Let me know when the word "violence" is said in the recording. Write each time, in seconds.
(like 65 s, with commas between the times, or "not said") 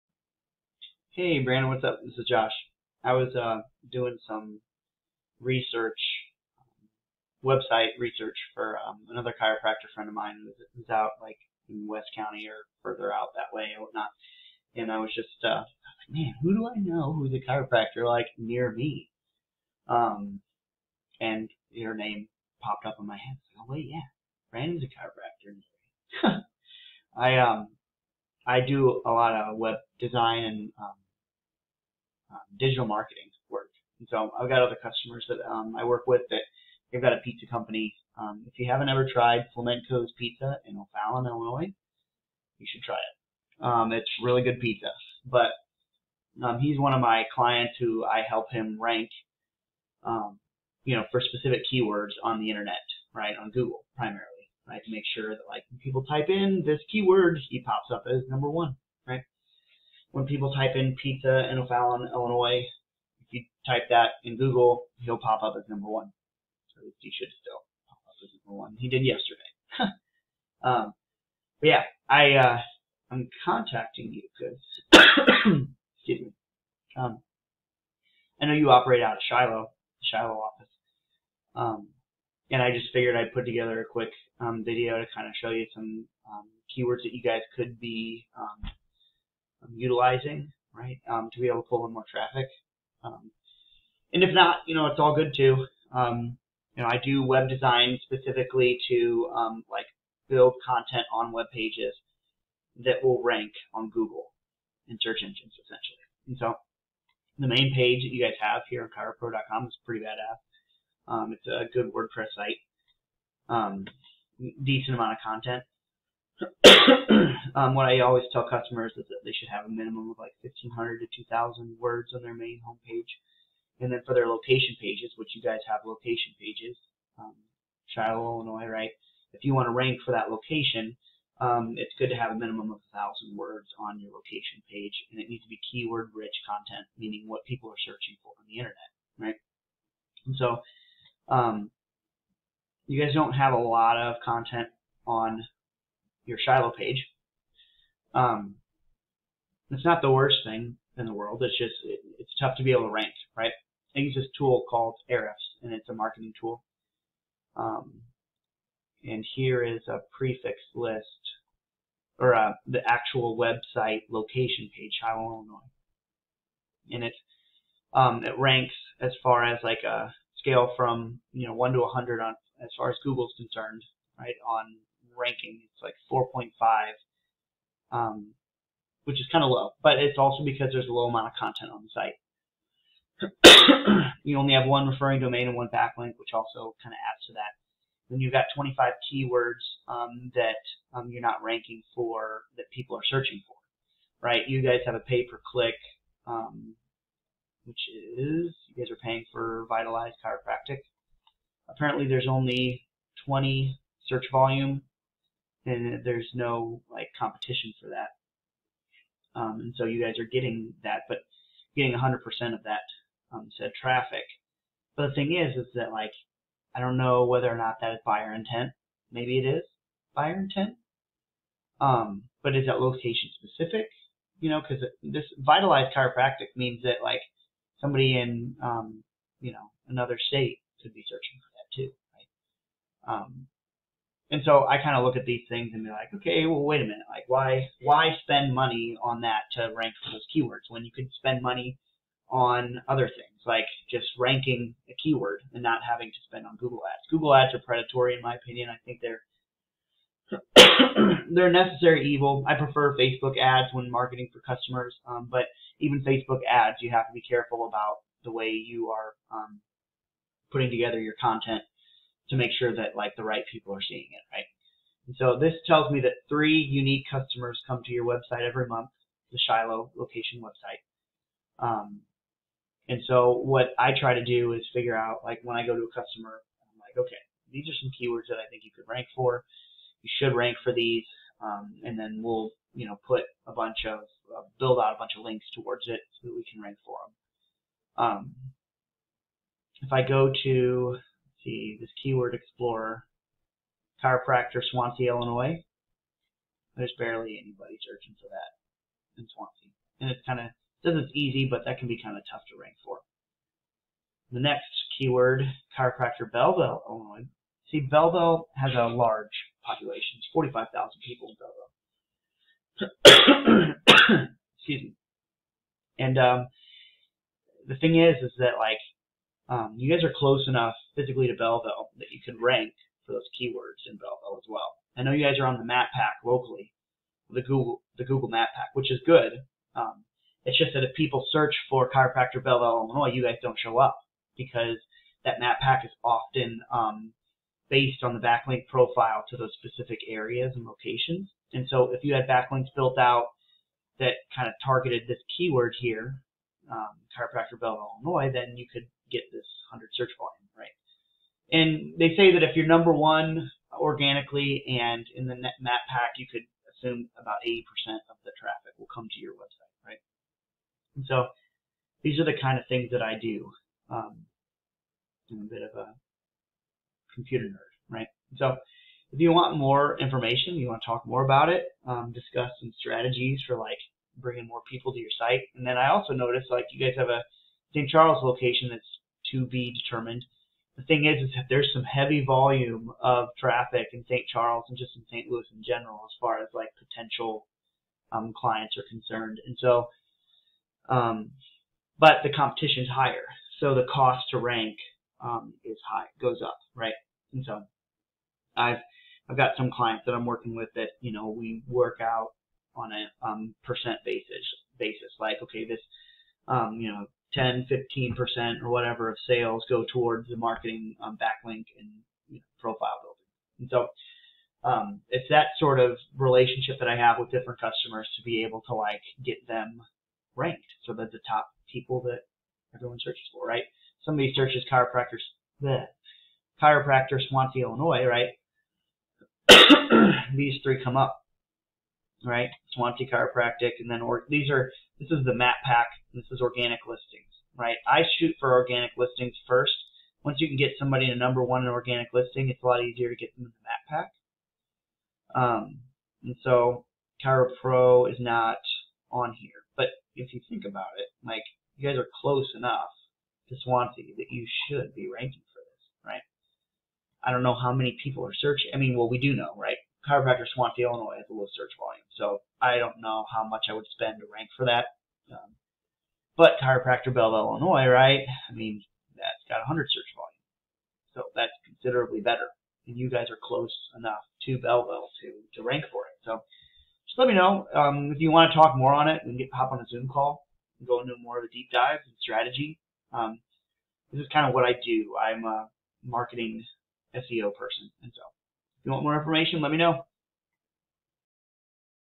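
not said.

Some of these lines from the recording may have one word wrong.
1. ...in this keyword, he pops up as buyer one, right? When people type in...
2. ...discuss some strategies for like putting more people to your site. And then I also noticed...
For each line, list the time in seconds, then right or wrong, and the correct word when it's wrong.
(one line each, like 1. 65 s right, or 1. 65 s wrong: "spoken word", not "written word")
1. 56 s wrong: "number", not "buyer"
2. 372 s wrong: "bringing", not "putting".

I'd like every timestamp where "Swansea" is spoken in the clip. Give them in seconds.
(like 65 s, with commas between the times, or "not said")
294 s, 299 s, 427 s, 432 s, 453 s, 460 s.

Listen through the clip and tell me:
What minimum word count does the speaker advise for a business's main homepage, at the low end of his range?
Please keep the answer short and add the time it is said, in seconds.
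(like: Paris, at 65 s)
1,500, at 120 s.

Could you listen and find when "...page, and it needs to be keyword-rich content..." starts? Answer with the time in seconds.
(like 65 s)
134 s.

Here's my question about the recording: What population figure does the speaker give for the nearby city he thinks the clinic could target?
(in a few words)
45,000.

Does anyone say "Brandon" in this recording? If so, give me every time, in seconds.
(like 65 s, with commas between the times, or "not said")
1 s, 24 s.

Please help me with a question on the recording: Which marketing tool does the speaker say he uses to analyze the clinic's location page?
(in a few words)
Ahrefs.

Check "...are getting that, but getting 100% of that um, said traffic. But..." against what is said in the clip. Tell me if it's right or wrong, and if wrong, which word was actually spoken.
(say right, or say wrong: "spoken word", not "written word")
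right.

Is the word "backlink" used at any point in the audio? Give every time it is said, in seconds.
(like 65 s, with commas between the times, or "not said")
185 s, 338 s, 342 s, 411 s.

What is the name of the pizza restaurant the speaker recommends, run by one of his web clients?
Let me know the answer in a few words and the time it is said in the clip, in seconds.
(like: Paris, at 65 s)
Flamenco's Pizza, at 39 s.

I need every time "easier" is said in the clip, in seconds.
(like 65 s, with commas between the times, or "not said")
442 s.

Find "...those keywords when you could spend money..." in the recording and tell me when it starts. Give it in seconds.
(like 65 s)
240 s.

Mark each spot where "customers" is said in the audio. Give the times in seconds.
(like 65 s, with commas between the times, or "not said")
34 s, 118 s, 254 s, 267 s, 275 s, 417 s.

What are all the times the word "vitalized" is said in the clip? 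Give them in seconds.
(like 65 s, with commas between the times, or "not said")
199 s, 225 s.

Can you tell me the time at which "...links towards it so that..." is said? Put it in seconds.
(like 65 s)
285 s.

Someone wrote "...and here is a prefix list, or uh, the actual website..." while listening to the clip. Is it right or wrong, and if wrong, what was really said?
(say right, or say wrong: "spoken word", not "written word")
right.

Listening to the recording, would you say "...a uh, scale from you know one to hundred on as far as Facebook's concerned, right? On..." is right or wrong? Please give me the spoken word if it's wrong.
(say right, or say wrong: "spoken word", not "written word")
wrong: "Google", not "Facebook".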